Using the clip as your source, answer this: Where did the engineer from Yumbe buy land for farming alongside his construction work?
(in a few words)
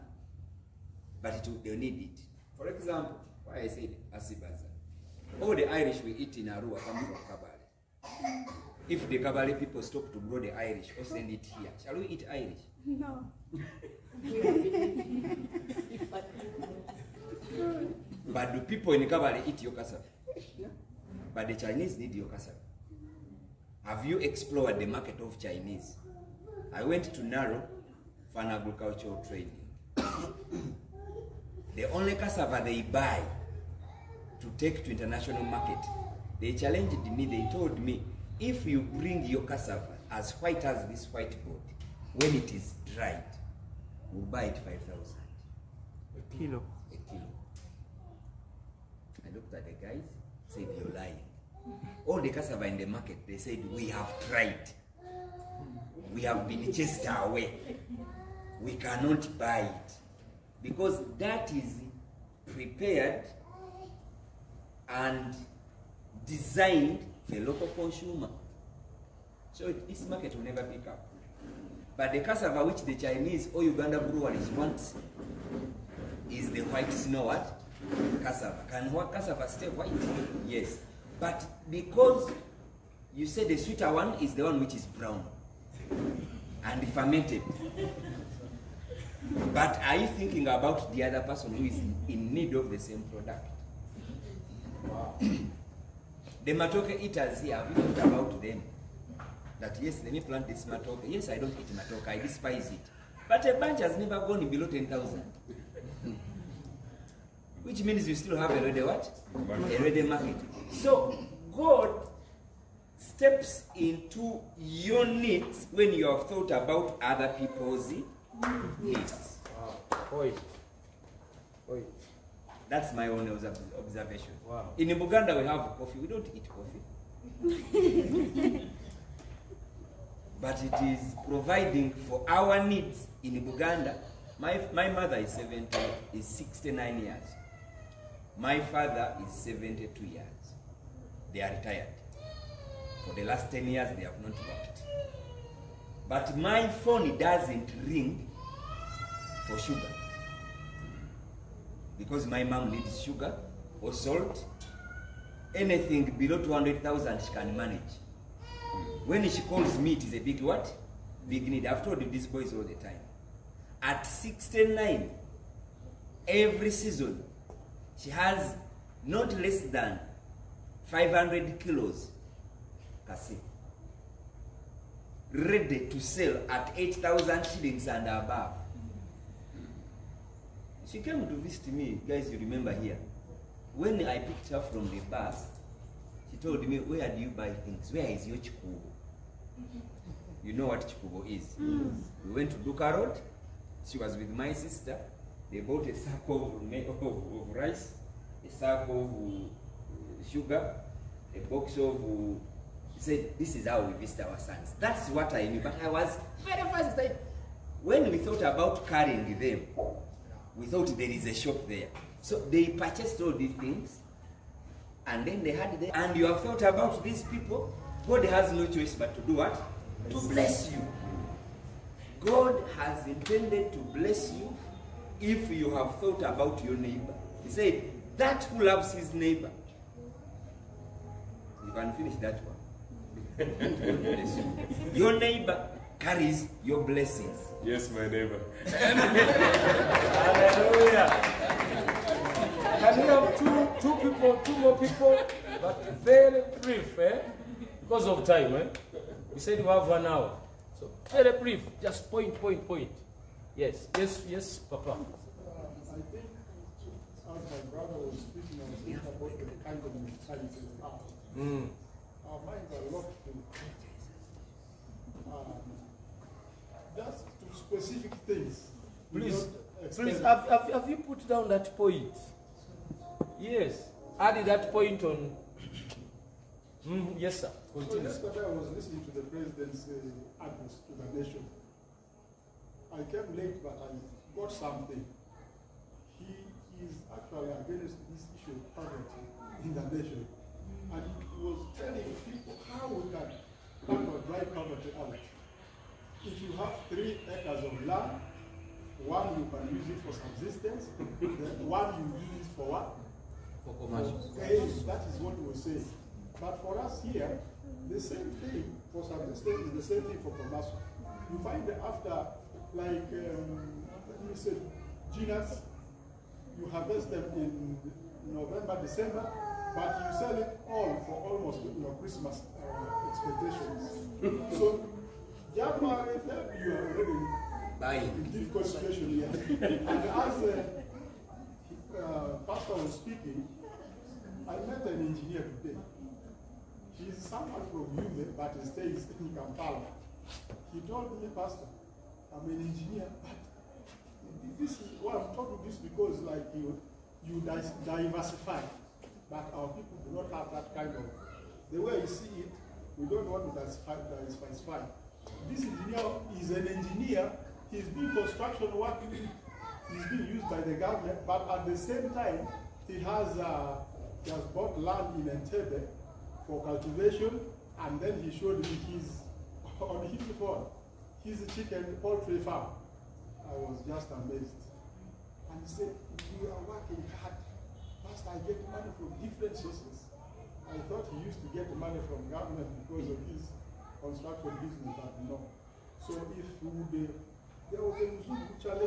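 Entebbe.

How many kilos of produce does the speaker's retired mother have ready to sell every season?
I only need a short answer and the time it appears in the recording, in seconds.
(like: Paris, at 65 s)
500 kilos, at 170 s.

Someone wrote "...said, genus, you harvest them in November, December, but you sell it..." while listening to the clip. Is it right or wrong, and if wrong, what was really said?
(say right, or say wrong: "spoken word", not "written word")
right.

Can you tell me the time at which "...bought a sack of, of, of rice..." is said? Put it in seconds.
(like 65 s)
195 s.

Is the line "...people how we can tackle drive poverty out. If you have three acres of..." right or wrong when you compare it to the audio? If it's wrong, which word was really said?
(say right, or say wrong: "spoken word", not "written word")
right.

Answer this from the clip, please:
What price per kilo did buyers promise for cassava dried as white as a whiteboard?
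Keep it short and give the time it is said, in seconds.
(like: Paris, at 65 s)
5,000, at 44 s.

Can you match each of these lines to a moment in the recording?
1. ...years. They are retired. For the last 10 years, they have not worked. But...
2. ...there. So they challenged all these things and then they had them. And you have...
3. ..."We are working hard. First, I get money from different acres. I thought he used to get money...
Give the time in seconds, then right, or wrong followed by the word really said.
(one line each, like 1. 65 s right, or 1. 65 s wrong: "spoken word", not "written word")
1. 140 s right
2. 211 s wrong: "purchased", not "challenged"
3. 376 s wrong: "sources", not "acres".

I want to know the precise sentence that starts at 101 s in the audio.
Yes, I don't eat matoke, I despise it.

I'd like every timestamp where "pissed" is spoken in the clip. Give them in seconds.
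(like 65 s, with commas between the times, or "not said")
not said.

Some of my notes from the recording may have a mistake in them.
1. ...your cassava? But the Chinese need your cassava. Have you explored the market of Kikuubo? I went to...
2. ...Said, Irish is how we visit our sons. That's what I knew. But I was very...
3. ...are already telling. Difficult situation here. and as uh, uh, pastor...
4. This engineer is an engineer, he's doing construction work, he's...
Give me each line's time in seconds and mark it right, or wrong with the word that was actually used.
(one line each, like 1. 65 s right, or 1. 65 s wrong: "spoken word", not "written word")
1. 19 s wrong: "Chinese", not "Kikuubo"
2. 203 s wrong: "This", not "Irish"
3. 326 s wrong: "buying", not "telling"
4. 355 s right.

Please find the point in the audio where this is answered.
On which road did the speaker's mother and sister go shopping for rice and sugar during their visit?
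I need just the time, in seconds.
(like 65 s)
192 s.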